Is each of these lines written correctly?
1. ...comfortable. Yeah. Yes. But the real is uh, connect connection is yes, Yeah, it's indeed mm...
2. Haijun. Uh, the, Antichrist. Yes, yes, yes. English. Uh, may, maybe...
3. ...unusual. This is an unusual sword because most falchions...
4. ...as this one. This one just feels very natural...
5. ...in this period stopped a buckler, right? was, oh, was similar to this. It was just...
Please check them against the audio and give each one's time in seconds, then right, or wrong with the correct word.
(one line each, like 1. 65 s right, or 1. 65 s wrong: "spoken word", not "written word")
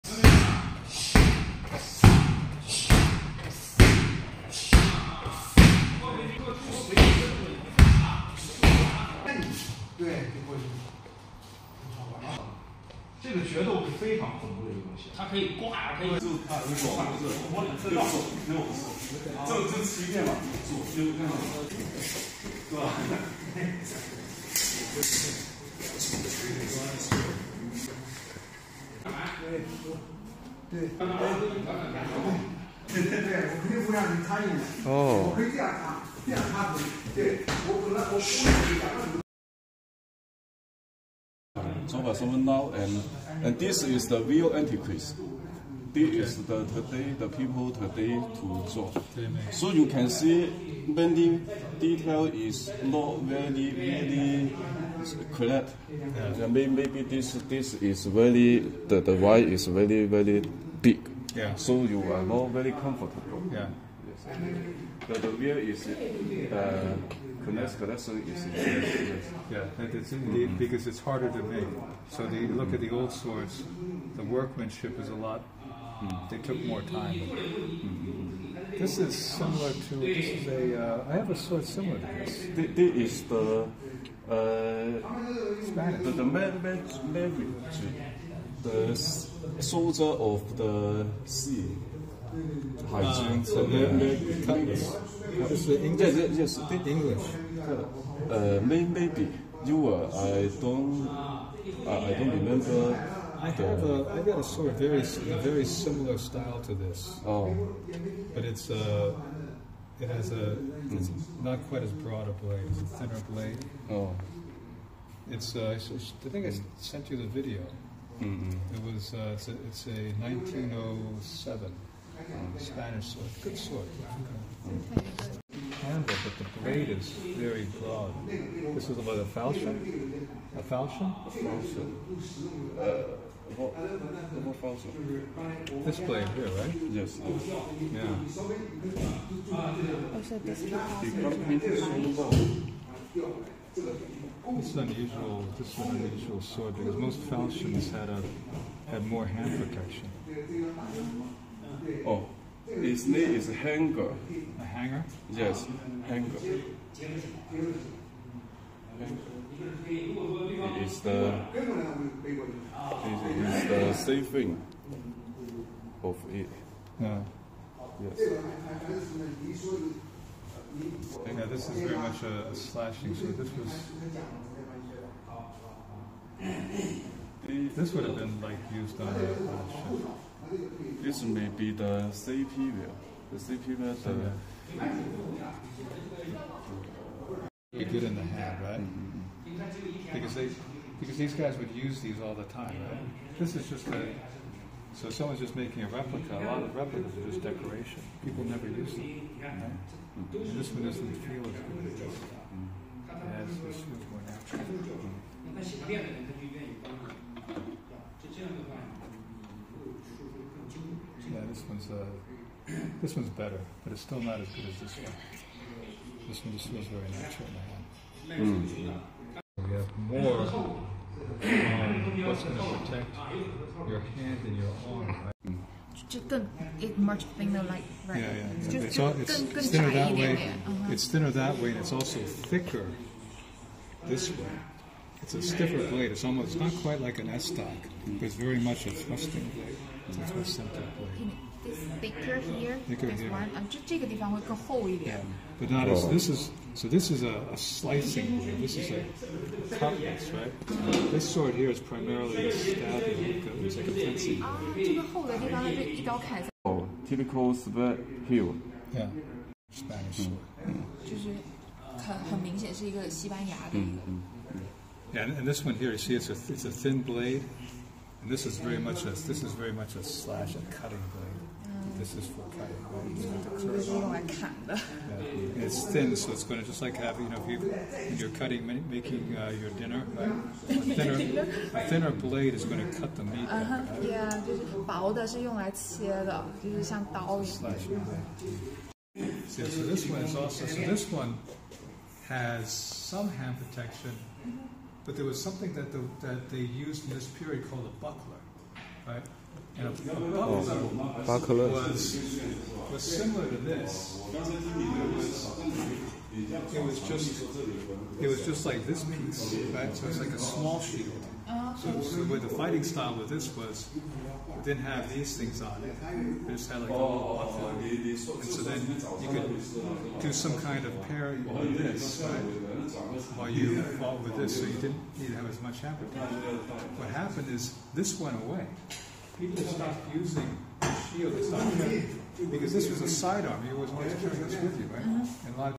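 1. 62 s right
2. 92 s wrong: "English", not "Antichrist"
3. 144 s right
4. 214 s right
5. 297 s wrong: "called", not "stopped".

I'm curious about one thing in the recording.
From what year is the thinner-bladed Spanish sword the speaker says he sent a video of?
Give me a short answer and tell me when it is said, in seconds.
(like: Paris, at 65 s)
1907, at 120 s.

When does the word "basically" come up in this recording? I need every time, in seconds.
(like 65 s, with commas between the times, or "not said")
not said.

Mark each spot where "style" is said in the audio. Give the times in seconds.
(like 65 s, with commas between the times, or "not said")
106 s, 312 s.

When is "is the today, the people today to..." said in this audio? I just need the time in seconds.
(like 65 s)
46 s.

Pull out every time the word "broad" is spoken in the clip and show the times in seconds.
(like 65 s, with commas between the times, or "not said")
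111 s, 127 s.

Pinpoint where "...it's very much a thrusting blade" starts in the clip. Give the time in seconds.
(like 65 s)
238 s.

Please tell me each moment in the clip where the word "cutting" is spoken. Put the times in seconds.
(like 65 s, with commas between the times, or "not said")
270 s, 278 s.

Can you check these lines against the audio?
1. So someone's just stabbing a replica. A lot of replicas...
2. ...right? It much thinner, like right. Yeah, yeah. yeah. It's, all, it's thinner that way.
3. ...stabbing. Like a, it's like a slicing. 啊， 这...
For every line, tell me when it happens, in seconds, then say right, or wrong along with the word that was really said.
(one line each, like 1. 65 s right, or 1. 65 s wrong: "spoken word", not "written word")
1. 194 s wrong: "making", not "stabbing"
2. 225 s right
3. 252 s wrong: "fencing", not "slicing".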